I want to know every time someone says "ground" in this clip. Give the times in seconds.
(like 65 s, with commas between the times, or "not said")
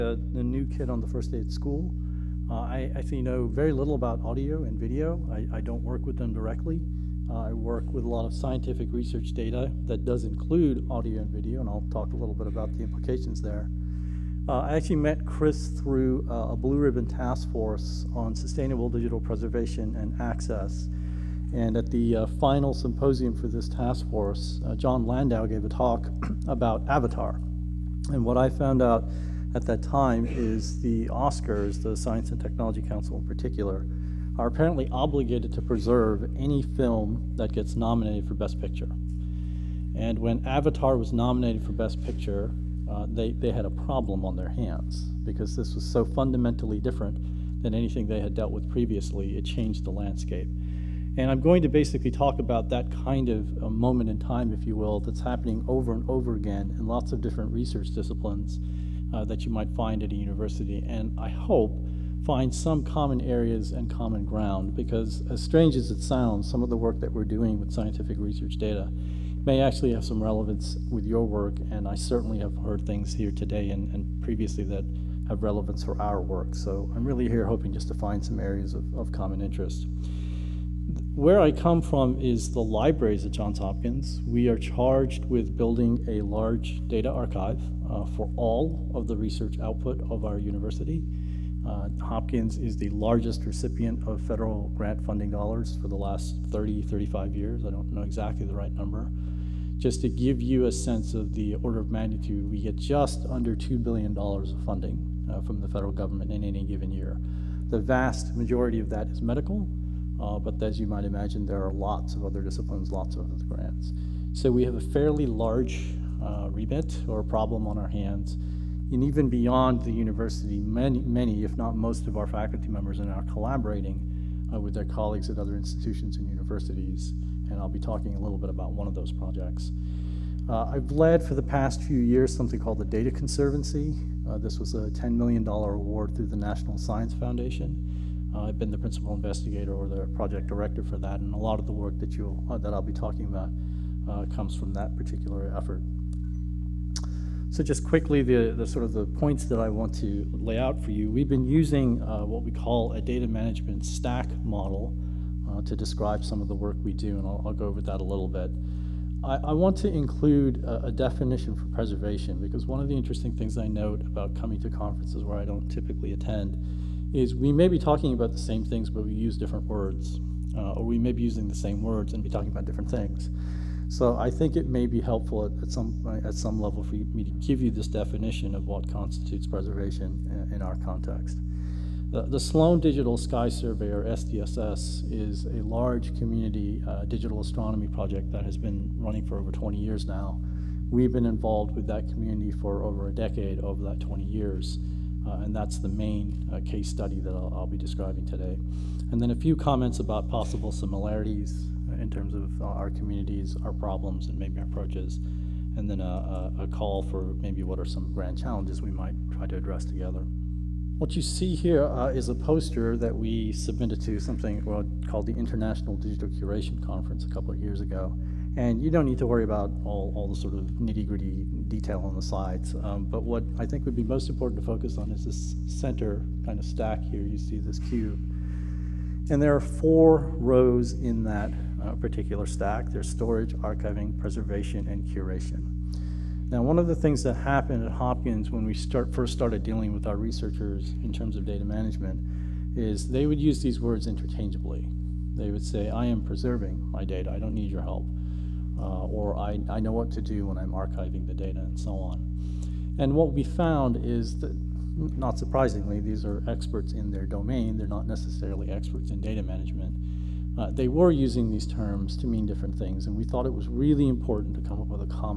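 64 s.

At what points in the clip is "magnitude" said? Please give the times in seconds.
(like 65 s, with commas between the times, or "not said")
101 s.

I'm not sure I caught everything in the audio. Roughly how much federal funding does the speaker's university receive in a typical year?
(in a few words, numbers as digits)
just under $2 billion.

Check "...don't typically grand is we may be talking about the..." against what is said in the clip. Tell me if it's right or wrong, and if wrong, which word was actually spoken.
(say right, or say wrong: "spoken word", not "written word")
wrong: "attend", not "grand".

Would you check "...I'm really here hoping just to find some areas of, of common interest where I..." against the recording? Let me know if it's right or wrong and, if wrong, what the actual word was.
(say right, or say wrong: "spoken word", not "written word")
right.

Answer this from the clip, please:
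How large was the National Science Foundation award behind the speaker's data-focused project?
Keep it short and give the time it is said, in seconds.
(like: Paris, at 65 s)
$10 million, at 134 s.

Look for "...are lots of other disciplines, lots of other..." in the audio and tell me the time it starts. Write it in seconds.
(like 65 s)
111 s.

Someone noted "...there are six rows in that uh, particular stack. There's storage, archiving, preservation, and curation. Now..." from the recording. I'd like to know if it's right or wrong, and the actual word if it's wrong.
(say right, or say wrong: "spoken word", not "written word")
wrong: "four", not "six".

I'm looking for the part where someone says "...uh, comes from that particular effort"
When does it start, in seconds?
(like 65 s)
144 s.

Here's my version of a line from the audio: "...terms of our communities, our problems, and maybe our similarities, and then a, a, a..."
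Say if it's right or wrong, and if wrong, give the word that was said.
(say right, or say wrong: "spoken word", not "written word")
wrong: "approaches", not "similarities".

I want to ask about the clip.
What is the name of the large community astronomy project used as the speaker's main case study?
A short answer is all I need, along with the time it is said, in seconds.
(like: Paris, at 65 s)
Sloan Digital Sky Survey, at 182 s.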